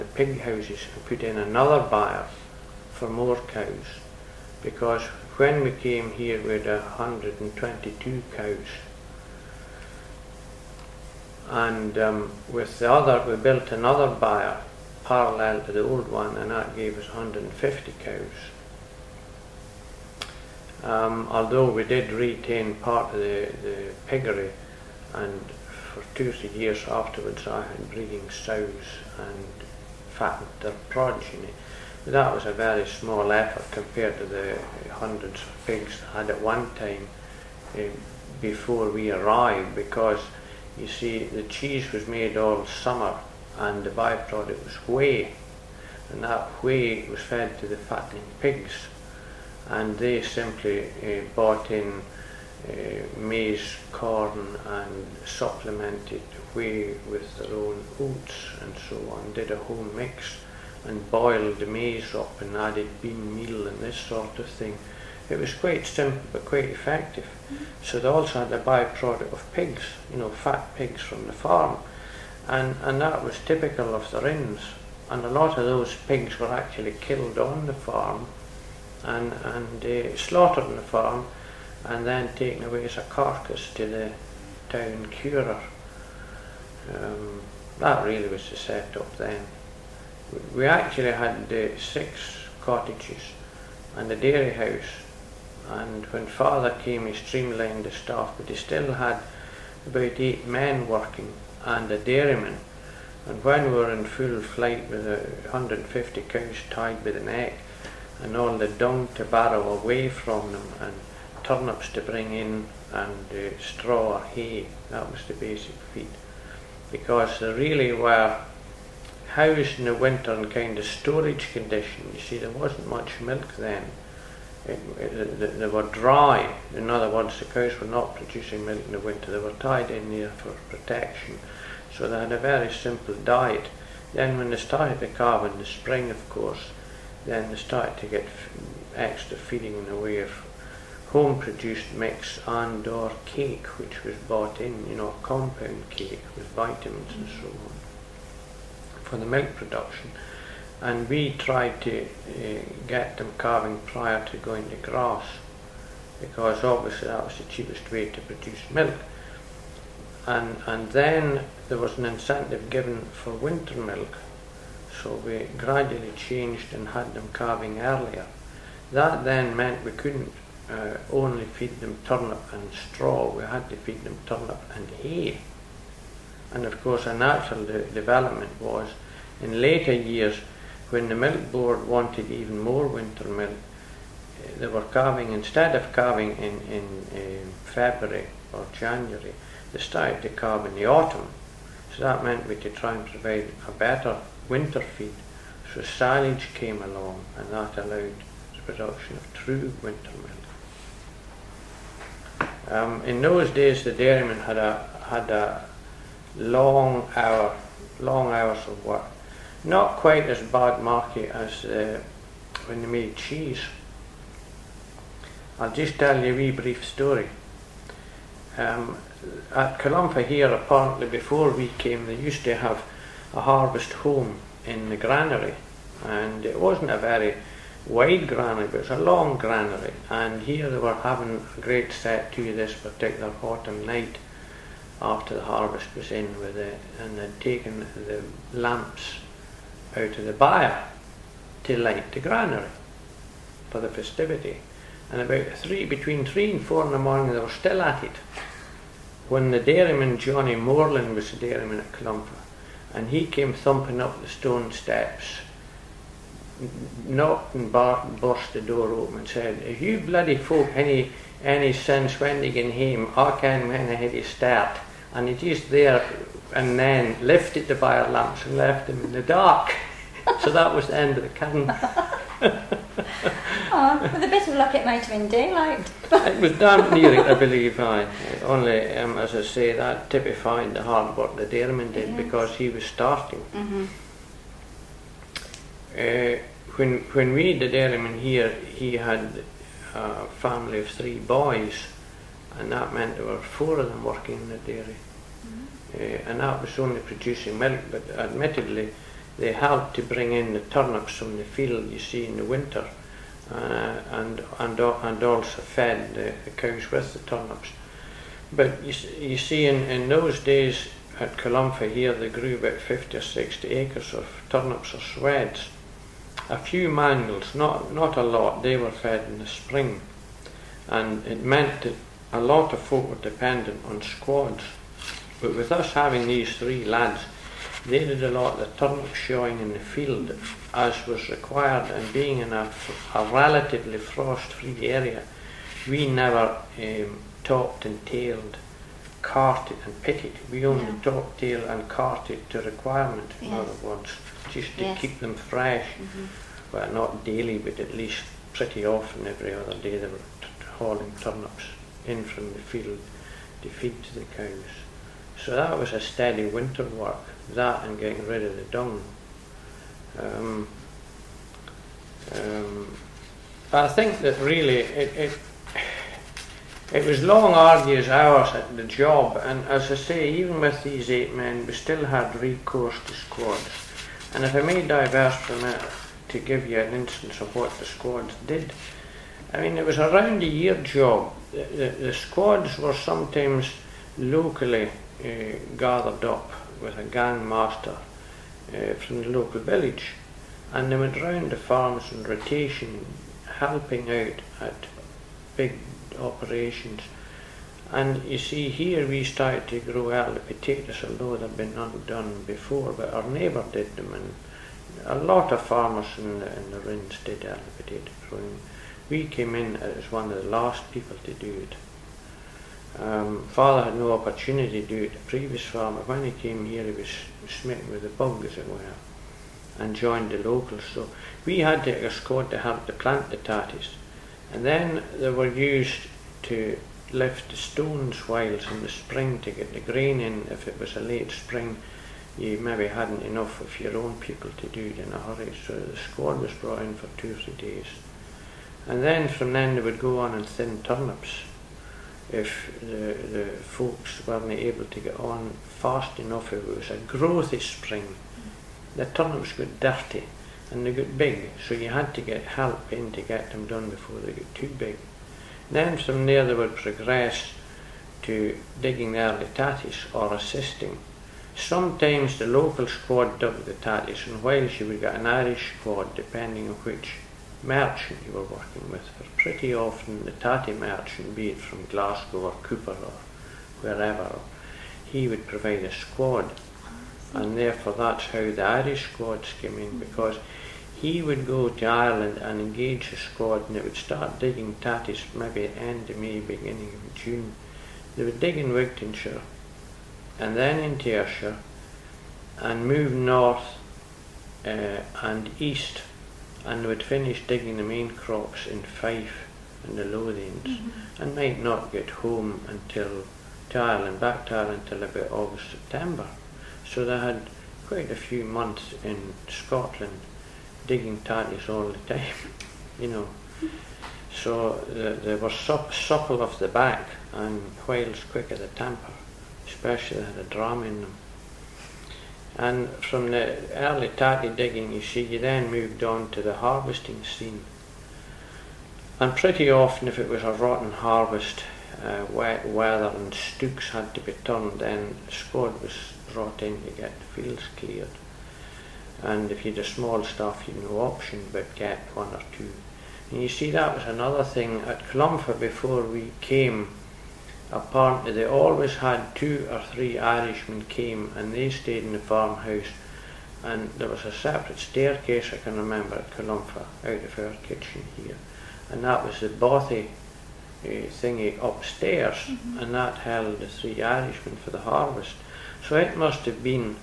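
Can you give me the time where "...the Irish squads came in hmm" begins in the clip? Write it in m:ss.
7:58.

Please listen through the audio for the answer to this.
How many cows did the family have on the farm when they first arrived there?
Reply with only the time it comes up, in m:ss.
0:06.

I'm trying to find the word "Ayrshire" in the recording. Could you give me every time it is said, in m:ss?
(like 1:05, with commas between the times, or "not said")
8:11.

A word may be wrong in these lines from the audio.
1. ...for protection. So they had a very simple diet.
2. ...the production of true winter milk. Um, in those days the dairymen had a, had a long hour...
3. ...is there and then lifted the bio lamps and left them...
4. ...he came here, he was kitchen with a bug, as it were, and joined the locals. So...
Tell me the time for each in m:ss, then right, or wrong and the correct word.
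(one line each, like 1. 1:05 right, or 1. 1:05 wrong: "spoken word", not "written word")
1. 2:10 right
2. 3:18 right
3. 4:25 right
4. 6:56 wrong: "smitten", not "kitchen".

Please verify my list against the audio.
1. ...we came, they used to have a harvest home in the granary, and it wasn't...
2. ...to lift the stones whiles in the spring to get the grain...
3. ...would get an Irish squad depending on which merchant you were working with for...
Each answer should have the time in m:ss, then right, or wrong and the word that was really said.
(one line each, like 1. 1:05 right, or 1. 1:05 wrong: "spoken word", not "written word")
1. 3:41 right
2. 7:06 right
3. 7:44 right.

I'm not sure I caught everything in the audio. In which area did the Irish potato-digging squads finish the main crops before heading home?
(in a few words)
Fife.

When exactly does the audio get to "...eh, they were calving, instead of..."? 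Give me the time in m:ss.
3:04.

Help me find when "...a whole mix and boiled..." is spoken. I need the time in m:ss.
0:59.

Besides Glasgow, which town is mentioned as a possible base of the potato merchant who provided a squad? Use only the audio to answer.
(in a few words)
Cupar.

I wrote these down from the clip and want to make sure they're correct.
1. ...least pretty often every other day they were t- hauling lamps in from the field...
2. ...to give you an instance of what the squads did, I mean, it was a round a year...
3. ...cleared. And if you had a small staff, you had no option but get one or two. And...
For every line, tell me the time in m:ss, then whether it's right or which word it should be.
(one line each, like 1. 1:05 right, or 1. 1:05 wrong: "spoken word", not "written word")
1. 5:47 wrong: "turnips", not "lamps"
2. 6:16 right
3. 8:57 right.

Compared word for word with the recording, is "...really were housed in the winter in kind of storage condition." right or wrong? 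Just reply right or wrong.
right.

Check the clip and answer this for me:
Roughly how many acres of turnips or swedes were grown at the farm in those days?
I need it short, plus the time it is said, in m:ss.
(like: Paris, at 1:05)
50 or 60 acres, at 5:12.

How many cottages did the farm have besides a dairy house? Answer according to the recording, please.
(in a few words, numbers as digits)
6.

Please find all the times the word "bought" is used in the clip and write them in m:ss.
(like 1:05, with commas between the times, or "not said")
0:51, 2:24.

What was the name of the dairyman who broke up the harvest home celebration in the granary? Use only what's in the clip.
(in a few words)
Johnny Moreland.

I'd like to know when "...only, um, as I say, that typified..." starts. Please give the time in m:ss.
4:38.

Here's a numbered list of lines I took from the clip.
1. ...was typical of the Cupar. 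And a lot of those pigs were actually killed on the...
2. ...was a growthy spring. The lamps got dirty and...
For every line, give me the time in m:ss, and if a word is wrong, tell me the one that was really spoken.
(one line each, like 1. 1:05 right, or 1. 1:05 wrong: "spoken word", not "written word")
1. 1:13 wrong: "Rins", not "Cupar"
2. 7:26 wrong: "turnips", not "lamps".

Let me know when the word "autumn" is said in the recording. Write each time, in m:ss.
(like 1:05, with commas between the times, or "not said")
3:10, 3:53.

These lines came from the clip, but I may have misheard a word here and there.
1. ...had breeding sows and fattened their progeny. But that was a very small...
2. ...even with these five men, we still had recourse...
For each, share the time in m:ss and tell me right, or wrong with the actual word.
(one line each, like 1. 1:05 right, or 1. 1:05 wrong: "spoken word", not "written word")
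1. 0:27 right
2. 6:10 wrong: "eight", not "five".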